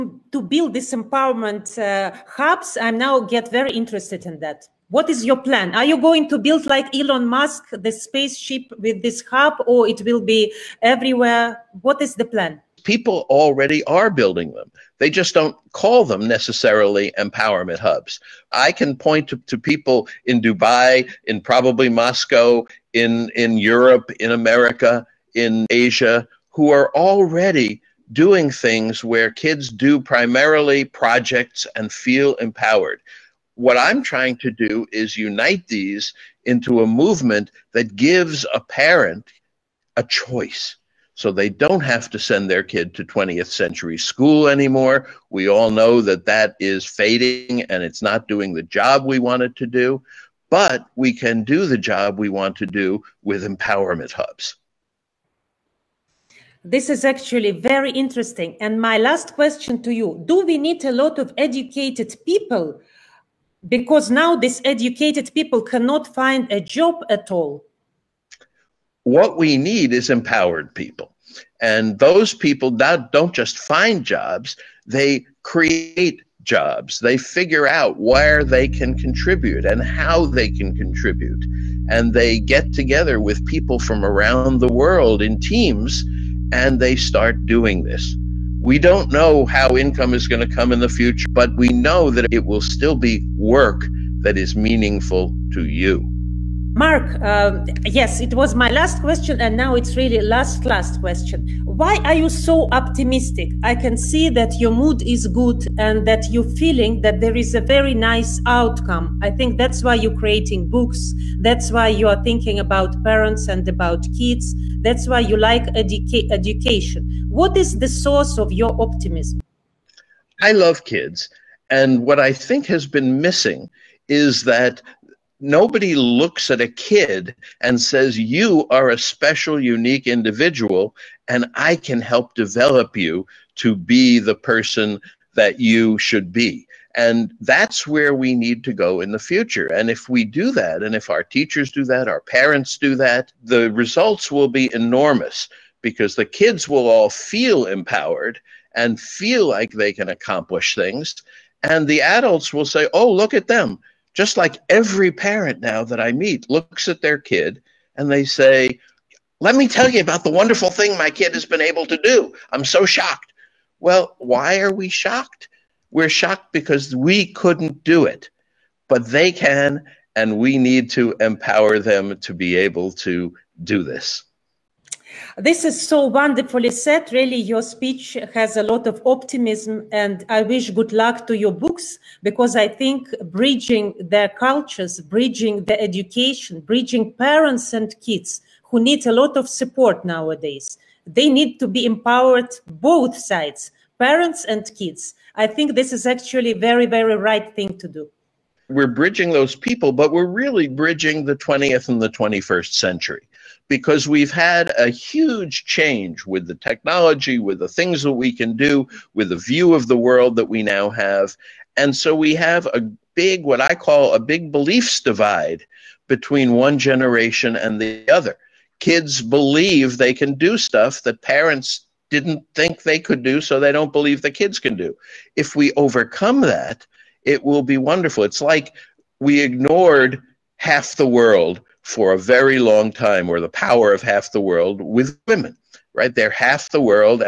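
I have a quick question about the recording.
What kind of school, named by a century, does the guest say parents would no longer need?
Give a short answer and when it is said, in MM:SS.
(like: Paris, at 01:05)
20th century school, at 00:43.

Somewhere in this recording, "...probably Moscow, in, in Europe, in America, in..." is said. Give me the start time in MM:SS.
00:21.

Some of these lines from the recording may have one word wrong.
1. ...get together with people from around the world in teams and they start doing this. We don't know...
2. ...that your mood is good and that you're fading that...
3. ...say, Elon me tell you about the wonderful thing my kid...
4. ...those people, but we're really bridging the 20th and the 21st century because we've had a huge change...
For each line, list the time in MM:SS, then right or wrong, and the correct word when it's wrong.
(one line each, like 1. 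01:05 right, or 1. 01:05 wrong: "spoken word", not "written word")
1. 01:22 right
2. 01:44 wrong: "feeling", not "fading"
3. 02:38 wrong: "Let", not "Elon"
4. 03:19 right.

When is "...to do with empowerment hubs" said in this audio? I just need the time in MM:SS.
00:52.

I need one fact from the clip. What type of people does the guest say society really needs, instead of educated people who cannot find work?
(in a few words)
Empowered people.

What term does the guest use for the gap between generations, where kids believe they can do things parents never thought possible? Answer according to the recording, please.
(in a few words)
Big beliefs divide.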